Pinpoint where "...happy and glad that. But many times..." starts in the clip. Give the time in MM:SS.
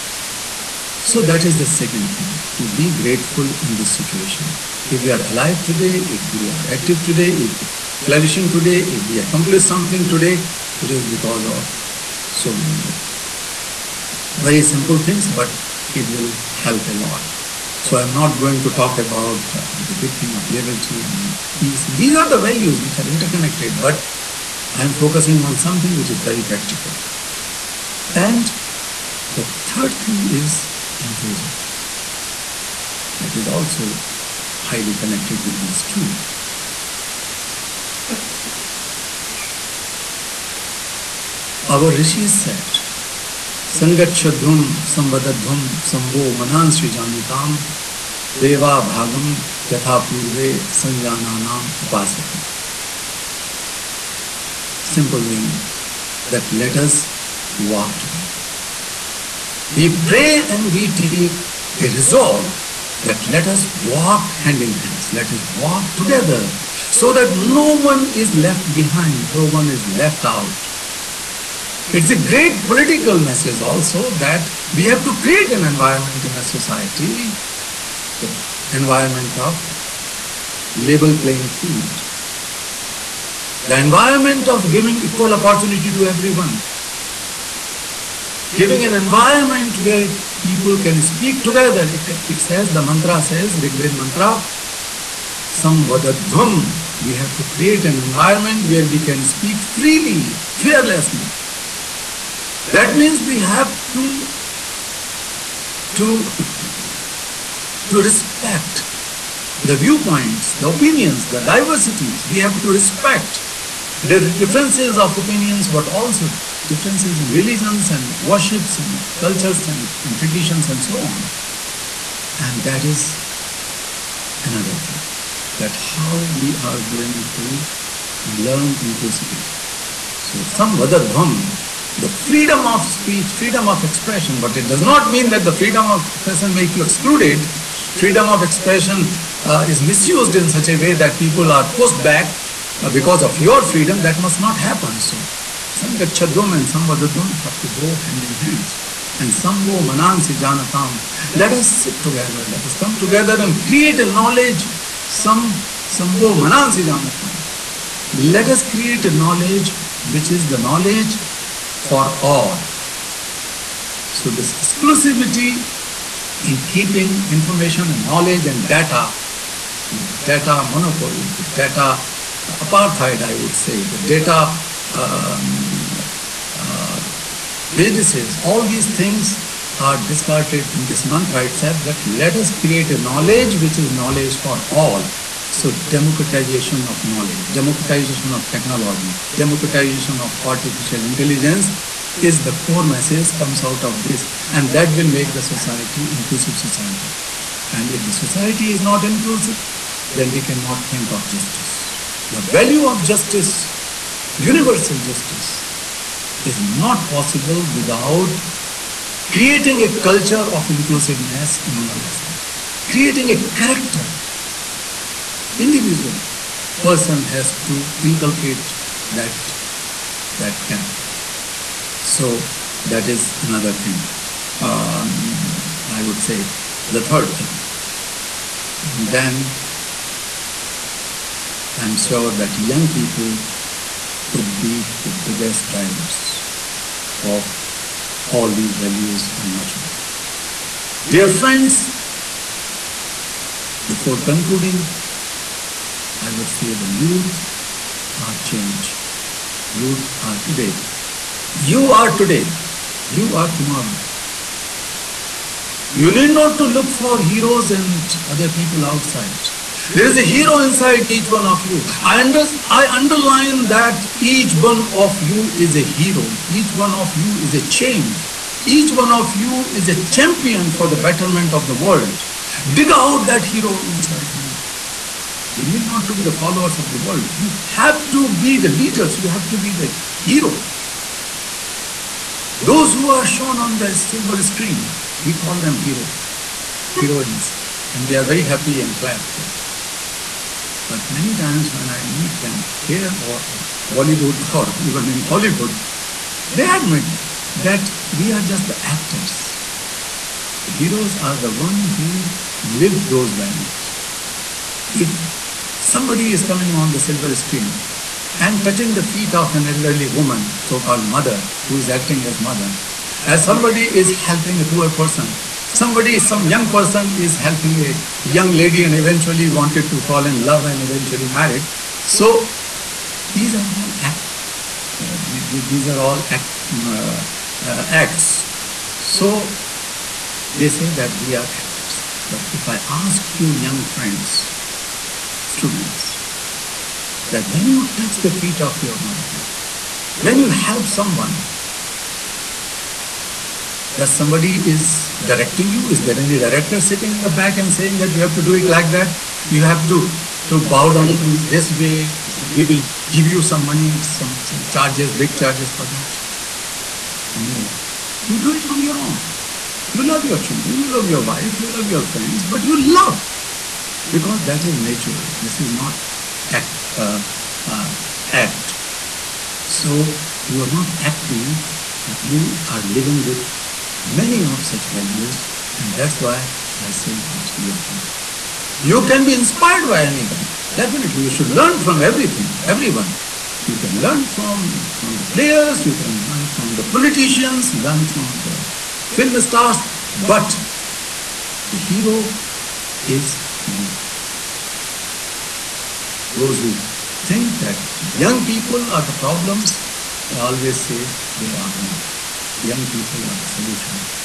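04:48.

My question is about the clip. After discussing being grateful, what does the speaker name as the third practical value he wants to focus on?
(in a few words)
Inclusion.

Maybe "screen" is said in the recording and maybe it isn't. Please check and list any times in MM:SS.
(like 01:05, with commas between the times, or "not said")
04:44, 05:07.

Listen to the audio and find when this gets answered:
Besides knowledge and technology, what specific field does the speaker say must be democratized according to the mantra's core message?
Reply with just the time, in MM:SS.
03:10.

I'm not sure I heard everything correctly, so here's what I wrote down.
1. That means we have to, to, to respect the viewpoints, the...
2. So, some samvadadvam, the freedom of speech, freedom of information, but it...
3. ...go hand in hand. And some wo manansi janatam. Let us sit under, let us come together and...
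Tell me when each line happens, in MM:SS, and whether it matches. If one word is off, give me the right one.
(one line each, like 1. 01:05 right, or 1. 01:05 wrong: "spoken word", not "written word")
1. 01:42 right
2. 02:10 wrong: "expression", not "information"
3. 02:27 wrong: "together", not "under".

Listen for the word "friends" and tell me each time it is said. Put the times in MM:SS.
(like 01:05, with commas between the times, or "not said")
04:01, 05:33, 06:02.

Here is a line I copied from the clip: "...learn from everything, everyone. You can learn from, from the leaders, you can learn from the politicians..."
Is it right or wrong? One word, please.
wrong.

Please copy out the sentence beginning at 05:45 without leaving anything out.
Is there any director sitting in the back and saying that you have to do it like that?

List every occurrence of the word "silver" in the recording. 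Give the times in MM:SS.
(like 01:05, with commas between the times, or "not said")
04:43, 05:06.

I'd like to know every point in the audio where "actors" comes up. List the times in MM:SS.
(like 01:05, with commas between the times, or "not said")
04:58, 05:31.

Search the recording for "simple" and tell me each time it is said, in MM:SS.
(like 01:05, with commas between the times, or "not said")
00:14, 00:54.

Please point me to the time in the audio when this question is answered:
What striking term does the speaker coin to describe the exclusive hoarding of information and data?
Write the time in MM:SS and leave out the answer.
02:51.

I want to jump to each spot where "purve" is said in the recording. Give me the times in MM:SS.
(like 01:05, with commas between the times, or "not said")
00:50.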